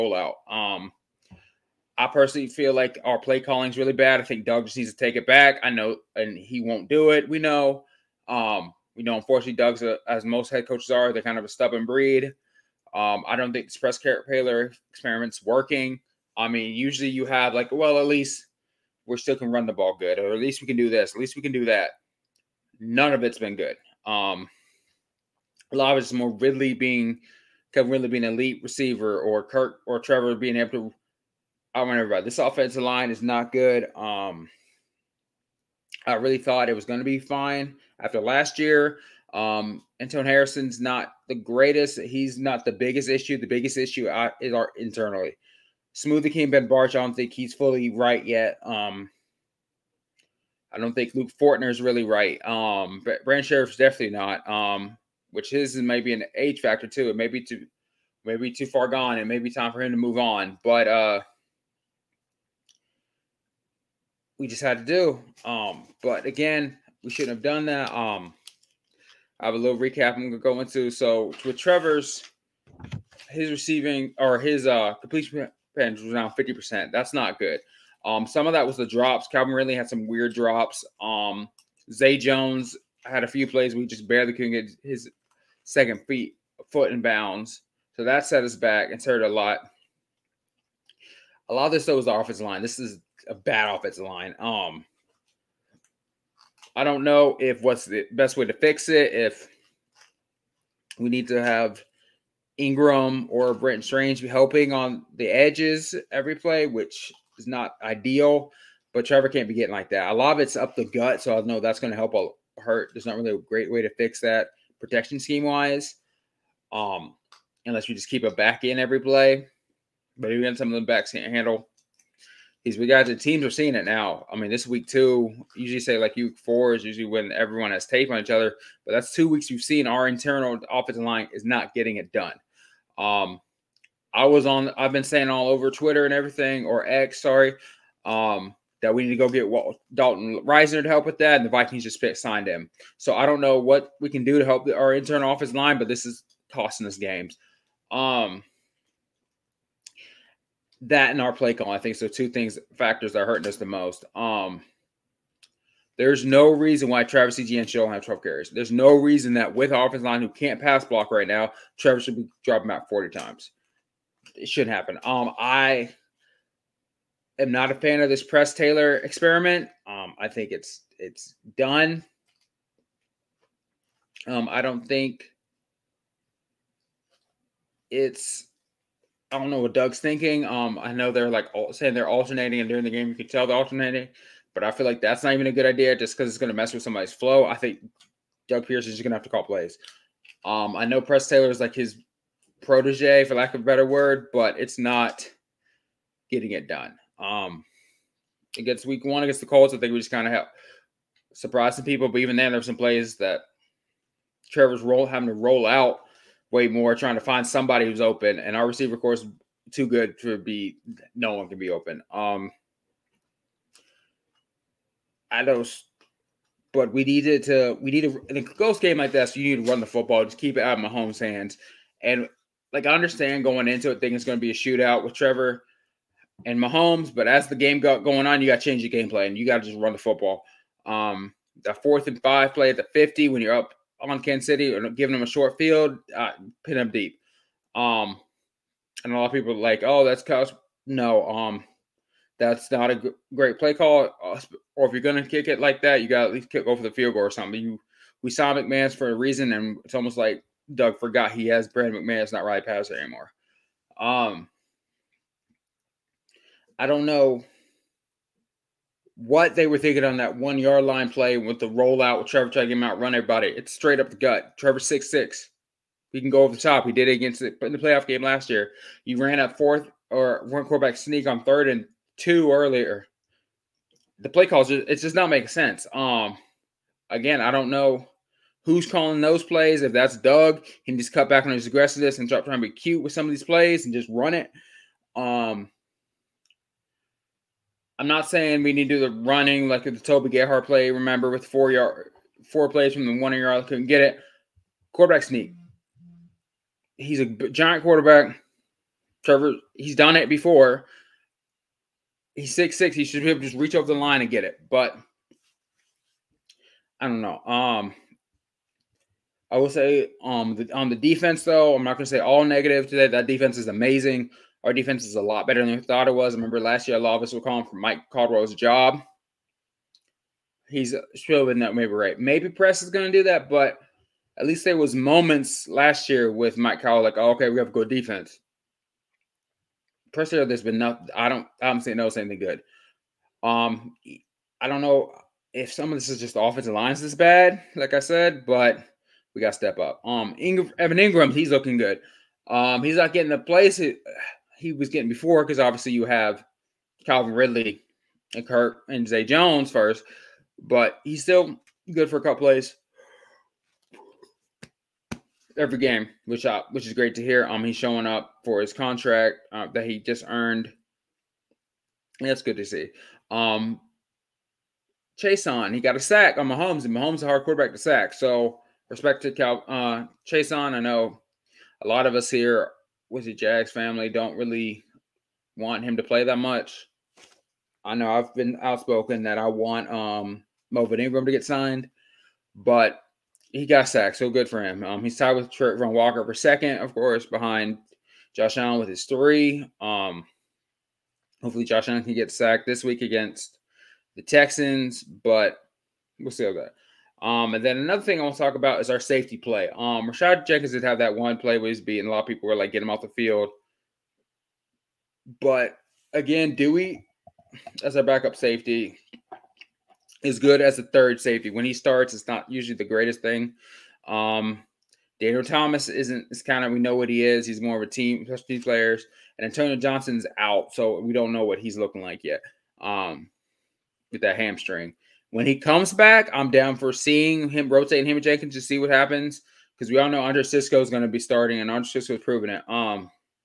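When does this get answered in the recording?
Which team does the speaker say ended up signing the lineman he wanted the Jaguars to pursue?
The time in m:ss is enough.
2:21.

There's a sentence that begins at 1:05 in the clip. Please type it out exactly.
Um, but again, we shouldn't have done that.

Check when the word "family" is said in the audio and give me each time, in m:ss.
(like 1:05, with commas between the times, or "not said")
6:13.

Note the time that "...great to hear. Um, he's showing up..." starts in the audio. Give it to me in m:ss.
5:56.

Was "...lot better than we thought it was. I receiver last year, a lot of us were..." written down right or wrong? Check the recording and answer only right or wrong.
wrong.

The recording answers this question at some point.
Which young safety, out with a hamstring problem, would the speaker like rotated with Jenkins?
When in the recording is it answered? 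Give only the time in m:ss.
6:59.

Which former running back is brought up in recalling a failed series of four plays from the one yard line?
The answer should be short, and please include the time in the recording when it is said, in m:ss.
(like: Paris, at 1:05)
Toby Gerhart, at 4:49.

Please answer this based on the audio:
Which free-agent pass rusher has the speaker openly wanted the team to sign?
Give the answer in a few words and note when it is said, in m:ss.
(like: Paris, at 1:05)
Melvin Ingram, at 6:20.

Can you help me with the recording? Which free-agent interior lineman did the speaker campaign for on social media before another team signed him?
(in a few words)
Dalton Risner.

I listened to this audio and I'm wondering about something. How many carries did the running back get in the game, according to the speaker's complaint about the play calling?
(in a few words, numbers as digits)
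12.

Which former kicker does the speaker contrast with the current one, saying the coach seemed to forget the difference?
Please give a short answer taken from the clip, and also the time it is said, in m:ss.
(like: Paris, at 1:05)
Riley Patterson, at 4:12.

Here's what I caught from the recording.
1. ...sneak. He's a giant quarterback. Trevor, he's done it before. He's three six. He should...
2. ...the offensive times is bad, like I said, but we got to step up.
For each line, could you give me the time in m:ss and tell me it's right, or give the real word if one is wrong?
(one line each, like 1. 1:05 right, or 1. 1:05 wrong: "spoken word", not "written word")
1. 4:55 wrong: "six", not "three"
2. 5:36 wrong: "lines", not "times".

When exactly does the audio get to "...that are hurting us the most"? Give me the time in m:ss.
2:33.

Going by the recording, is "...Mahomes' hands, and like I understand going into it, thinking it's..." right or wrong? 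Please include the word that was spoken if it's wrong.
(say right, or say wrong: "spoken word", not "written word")
right.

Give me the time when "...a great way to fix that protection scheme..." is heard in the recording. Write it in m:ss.
1:53.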